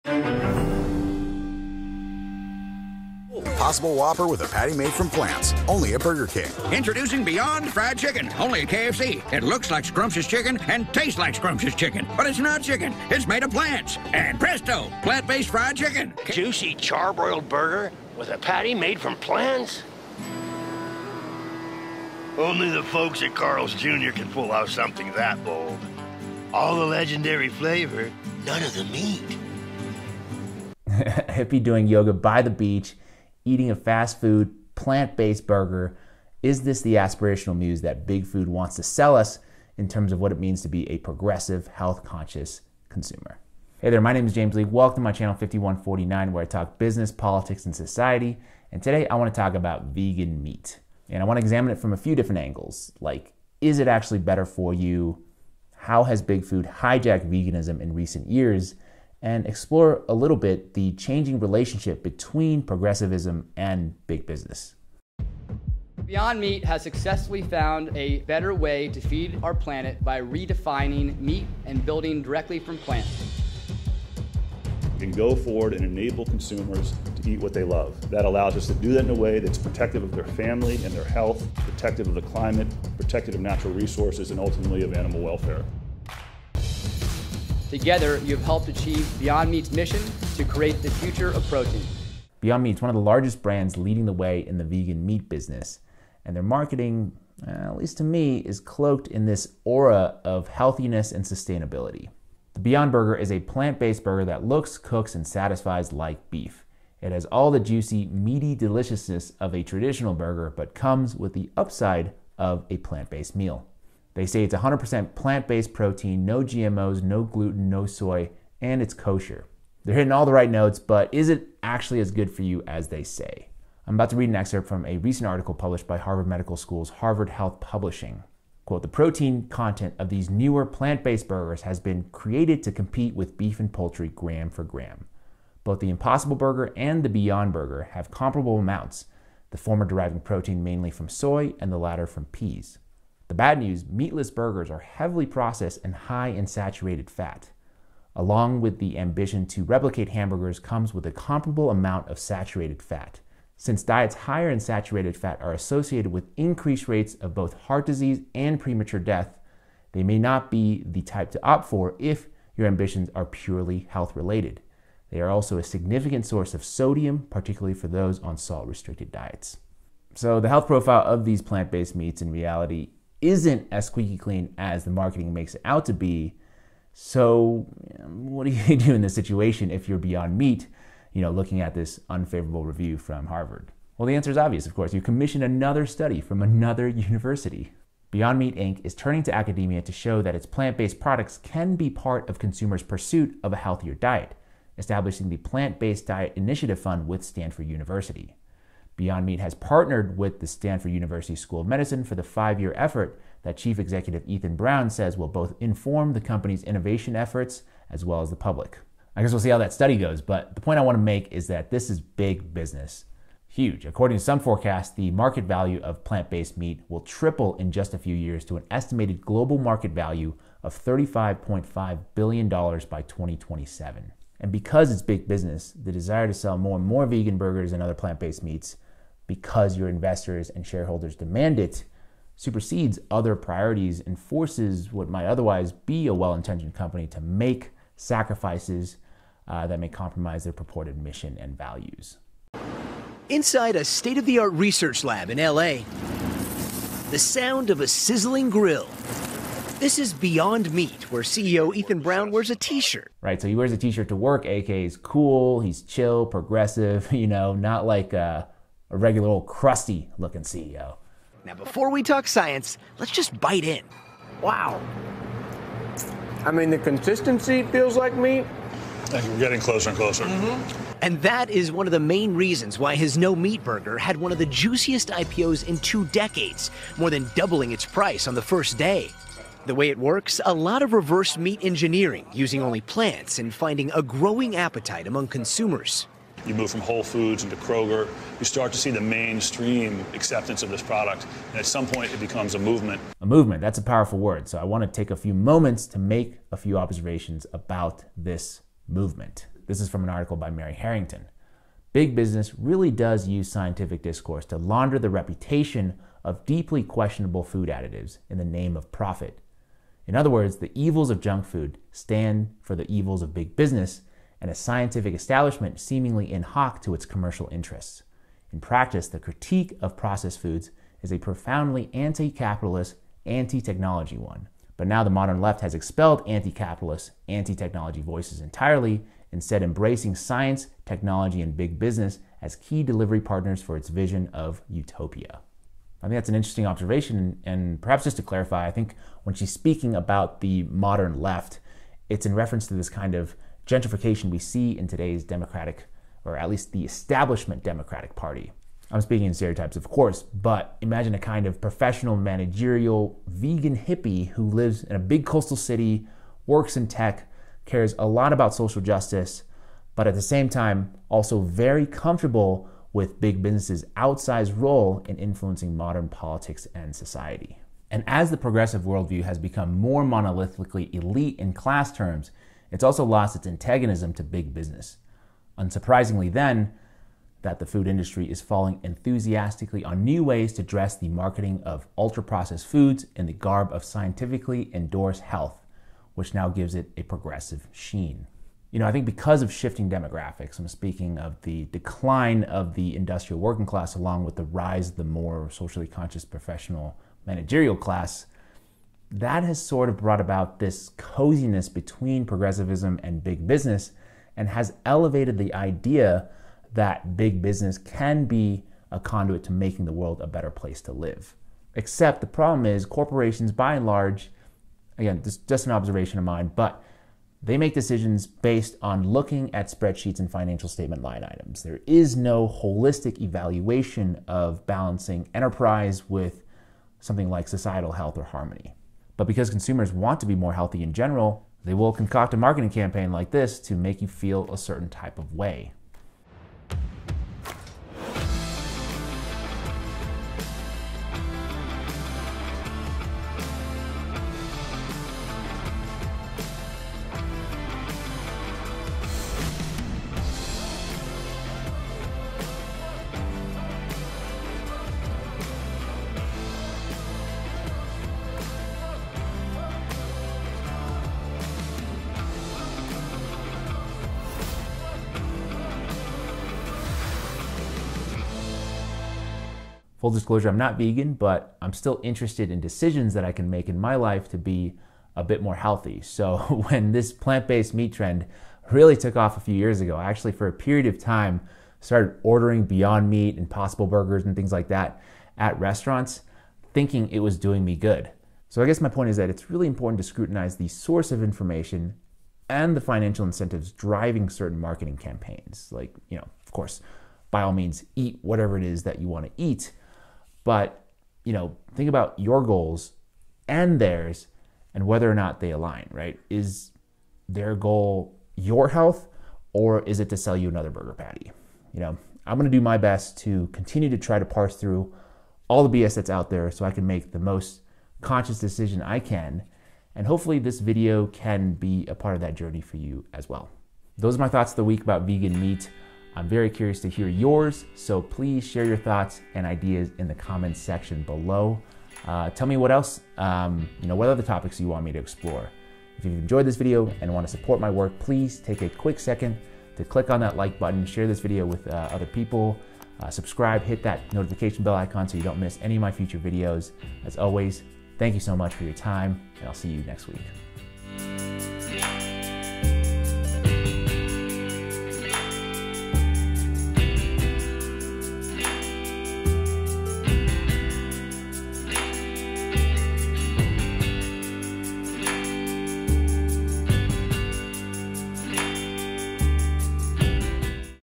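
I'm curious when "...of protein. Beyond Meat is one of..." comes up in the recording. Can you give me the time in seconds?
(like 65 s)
91 s.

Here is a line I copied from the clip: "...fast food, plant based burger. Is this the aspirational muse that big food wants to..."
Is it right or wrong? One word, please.
right.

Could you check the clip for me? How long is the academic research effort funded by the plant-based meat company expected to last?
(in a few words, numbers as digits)
5 years.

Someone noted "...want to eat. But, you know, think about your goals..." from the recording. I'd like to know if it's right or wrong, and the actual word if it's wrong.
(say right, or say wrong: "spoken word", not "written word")
right.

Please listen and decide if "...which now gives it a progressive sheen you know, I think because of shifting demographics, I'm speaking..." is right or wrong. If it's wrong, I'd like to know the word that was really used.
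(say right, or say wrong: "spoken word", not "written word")
right.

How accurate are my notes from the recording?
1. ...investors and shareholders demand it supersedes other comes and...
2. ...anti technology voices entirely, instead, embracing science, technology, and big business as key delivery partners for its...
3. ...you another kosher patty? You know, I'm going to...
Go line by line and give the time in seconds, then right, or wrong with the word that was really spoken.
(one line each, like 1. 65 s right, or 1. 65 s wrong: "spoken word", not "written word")
1. 229 s wrong: "priorities", not "comes"
2. 327 s right
3. 510 s wrong: "burger", not "kosher".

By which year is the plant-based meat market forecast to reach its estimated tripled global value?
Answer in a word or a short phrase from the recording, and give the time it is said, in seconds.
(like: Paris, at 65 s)
2027, at 223 s.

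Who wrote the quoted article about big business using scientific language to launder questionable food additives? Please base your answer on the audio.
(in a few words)
Mary Harrington.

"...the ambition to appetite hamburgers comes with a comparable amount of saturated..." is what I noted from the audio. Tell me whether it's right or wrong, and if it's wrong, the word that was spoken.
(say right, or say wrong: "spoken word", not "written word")
wrong: "replicate", not "appetite".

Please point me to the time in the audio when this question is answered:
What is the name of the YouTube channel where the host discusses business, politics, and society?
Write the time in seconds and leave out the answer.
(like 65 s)
45 s.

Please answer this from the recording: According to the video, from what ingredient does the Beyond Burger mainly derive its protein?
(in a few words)
peas.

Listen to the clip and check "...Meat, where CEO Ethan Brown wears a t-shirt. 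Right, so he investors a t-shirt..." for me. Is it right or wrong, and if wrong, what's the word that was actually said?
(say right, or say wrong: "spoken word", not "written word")
wrong: "wears", not "investors".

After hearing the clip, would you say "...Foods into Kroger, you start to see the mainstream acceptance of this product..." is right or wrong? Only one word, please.
right.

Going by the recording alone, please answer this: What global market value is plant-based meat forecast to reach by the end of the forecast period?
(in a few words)
$35.5 billion.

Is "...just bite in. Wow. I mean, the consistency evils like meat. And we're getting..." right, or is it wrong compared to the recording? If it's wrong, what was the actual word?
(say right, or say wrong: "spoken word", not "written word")
wrong: "feels", not "evils".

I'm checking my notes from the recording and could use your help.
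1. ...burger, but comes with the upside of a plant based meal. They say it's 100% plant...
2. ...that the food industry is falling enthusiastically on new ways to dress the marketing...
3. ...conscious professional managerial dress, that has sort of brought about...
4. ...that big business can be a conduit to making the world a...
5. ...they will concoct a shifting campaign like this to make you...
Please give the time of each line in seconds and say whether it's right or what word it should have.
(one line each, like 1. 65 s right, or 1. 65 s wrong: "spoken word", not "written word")
1. 110 s right
2. 377 s right
3. 395 s wrong: "class", not "dress"
4. 406 s right
5. 431 s wrong: "marketing", not "shifting".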